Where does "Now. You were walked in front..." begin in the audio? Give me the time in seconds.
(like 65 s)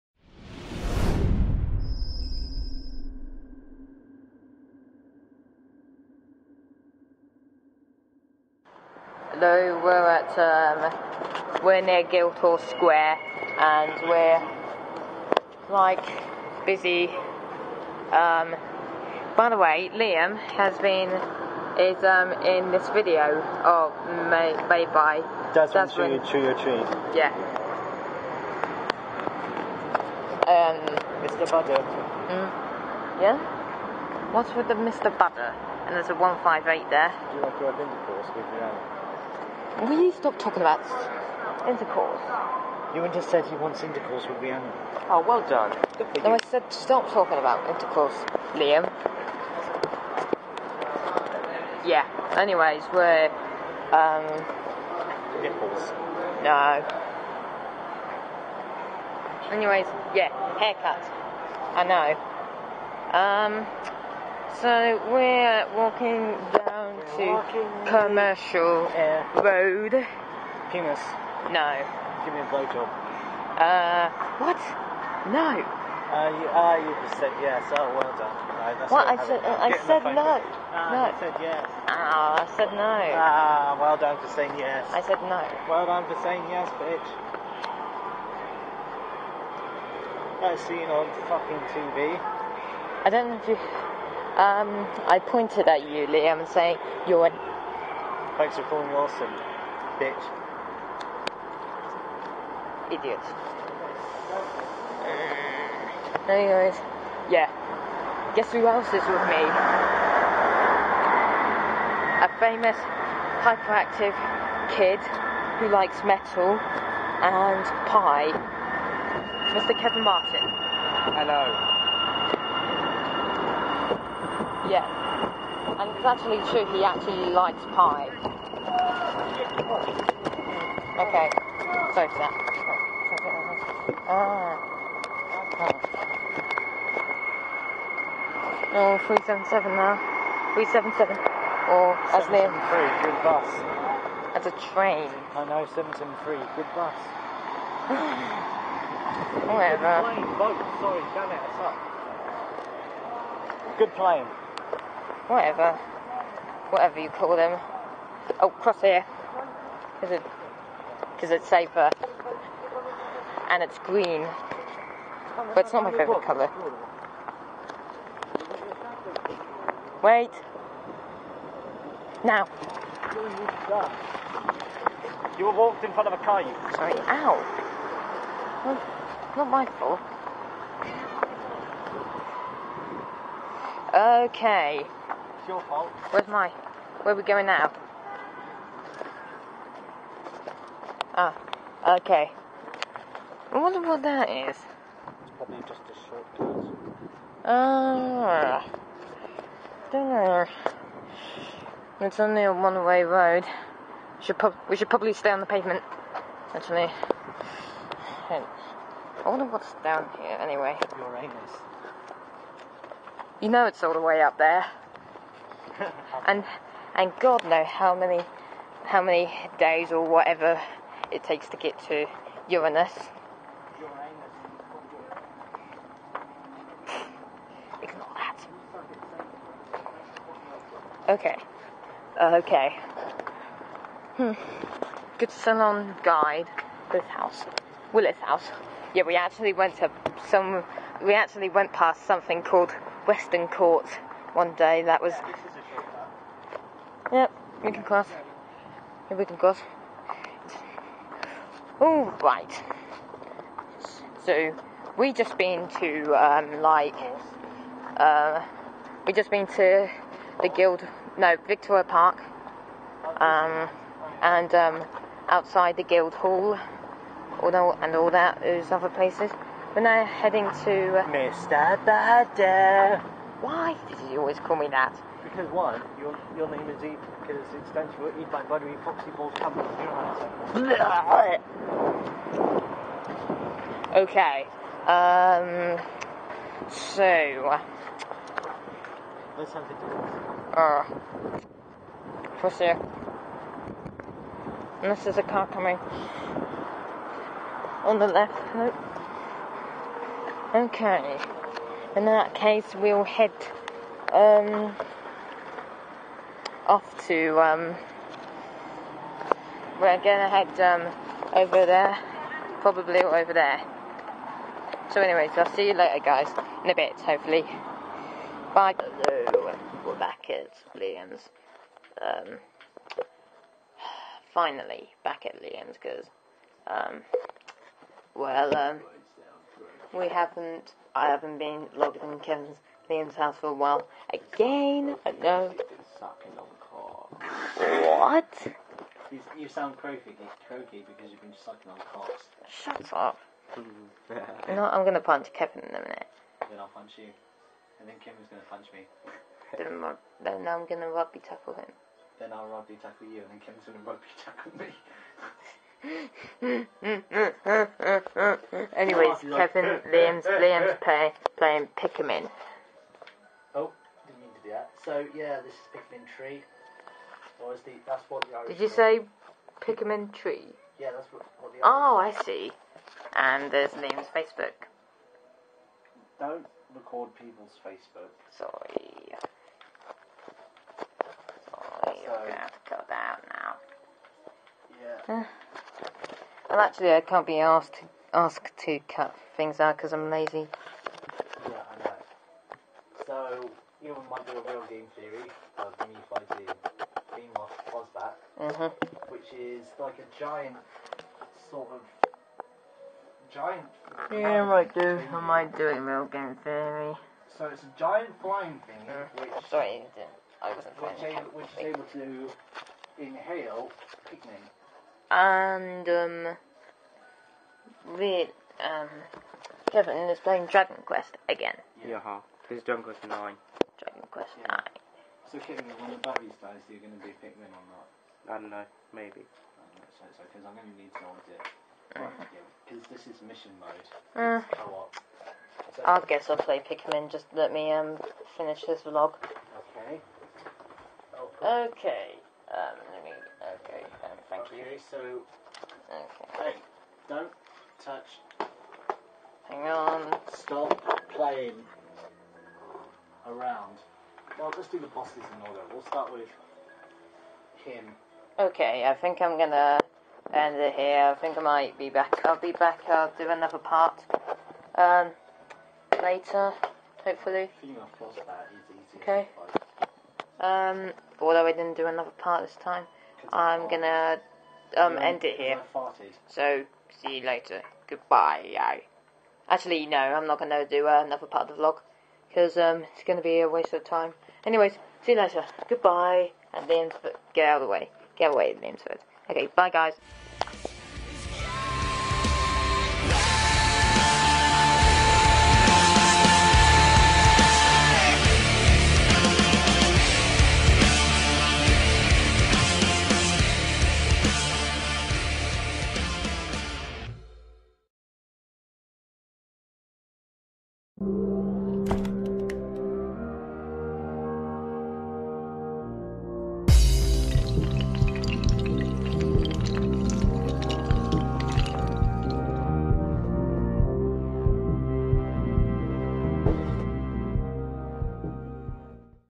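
172 s.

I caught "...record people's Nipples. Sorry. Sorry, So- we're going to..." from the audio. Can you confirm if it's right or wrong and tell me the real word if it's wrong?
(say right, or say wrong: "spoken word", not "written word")
wrong: "Facebook", not "Nipples".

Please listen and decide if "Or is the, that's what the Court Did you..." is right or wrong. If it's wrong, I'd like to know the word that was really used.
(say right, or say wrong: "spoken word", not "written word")
wrong: "Irish", not "Court".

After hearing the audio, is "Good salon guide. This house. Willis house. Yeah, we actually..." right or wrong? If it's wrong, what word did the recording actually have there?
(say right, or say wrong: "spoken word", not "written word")
right.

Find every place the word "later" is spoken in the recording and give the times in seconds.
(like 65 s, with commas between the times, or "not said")
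315 s, 466 s, 477 s, 485 s.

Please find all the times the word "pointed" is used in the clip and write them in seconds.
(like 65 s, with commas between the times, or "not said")
95 s.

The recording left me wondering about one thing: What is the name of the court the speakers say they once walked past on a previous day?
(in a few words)
Western Court.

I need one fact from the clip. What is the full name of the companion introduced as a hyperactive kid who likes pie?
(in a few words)
Kevin Martin.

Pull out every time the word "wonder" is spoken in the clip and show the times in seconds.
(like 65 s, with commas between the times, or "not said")
193 s, 209 s.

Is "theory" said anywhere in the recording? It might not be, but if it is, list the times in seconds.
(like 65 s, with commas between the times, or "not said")
394 s, 406 s.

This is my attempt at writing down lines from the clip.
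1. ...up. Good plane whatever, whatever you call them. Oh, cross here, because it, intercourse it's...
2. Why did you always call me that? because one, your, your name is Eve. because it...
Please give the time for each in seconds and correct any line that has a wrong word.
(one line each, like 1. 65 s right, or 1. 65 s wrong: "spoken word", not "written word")
1. 151 s wrong: "cause", not "intercourse"
2. 273 s right.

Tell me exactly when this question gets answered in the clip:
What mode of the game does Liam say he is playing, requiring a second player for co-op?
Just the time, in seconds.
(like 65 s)
433 s.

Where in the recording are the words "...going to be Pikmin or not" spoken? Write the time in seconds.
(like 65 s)
426 s.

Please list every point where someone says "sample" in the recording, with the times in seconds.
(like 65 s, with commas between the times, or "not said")
not said.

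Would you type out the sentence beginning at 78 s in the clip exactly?
Right, uh, that's what I said, I said no.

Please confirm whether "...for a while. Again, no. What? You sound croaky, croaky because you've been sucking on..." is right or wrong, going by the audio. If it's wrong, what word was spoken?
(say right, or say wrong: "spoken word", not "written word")
right.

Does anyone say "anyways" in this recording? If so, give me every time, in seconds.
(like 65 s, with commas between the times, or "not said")
52 s, 59 s, 106 s, 210 s, 315 s, 358 s, 484 s.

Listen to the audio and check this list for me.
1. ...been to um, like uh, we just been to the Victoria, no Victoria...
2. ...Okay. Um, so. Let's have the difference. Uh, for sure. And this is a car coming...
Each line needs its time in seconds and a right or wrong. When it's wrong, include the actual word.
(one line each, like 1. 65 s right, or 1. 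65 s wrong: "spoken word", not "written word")
1. 255 s wrong: "Guild", not "Victoria"
2. 283 s right.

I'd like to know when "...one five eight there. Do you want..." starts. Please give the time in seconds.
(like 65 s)
36 s.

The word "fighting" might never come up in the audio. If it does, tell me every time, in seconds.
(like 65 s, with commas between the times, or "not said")
396 s.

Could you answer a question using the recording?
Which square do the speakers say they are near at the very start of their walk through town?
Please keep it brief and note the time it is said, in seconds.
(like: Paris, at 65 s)
Guildhall Square, at 12 s.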